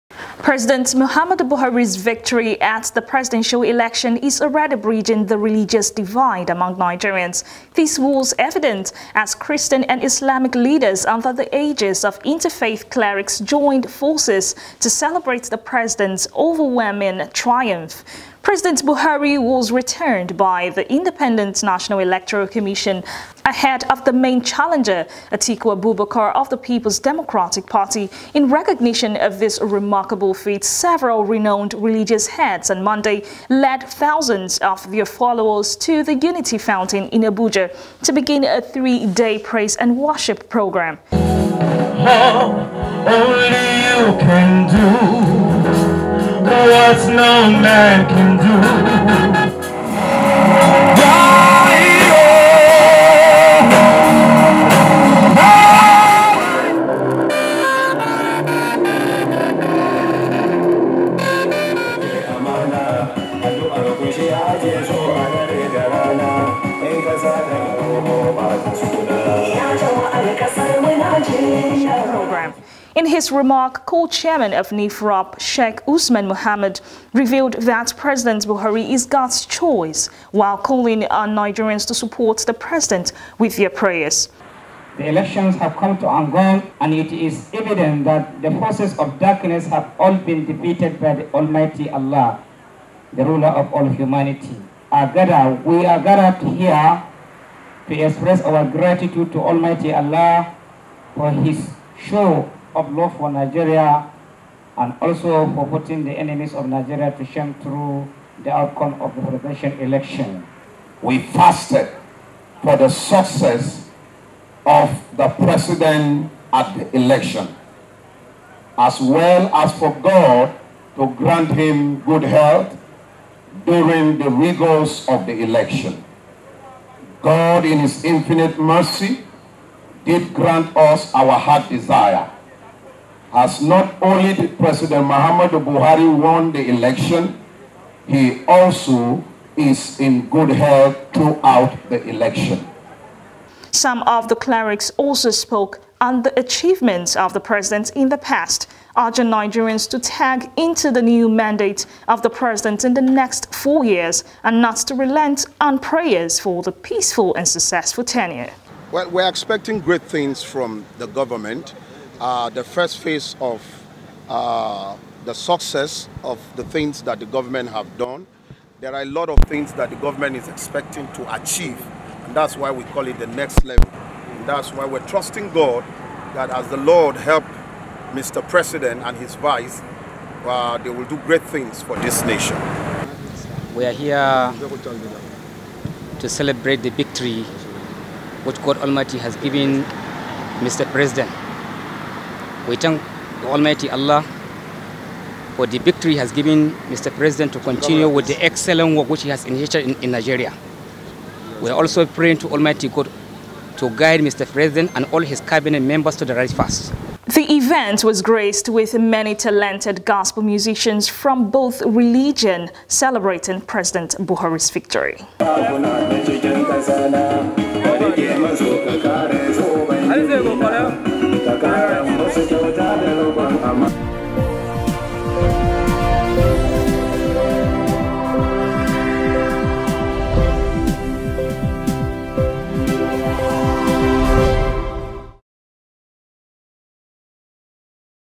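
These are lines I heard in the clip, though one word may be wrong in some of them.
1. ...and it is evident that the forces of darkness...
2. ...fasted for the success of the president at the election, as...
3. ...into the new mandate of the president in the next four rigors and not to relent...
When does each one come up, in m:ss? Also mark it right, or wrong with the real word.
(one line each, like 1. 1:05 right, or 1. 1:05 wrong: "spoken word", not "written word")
1. 1:26 right
2. 1:51 right
3. 2:30 wrong: "years", not "rigors".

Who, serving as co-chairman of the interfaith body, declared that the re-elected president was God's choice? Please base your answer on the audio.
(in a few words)
Sheikh Usman Mohammed.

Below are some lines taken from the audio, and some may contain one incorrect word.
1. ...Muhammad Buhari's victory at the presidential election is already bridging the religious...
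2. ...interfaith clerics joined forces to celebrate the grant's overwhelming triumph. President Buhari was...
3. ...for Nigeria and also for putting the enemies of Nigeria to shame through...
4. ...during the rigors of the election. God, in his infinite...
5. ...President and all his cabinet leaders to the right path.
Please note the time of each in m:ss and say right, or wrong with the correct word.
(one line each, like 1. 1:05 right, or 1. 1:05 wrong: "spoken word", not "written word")
1. 0:00 right
2. 0:12 wrong: "president", not "grant"
3. 1:43 right
4. 2:03 right
5. 3:24 wrong: "members", not "leaders".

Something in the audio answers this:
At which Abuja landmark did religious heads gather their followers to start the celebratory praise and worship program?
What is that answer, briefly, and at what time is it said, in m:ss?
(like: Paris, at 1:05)
Unity Fountain, at 0:36.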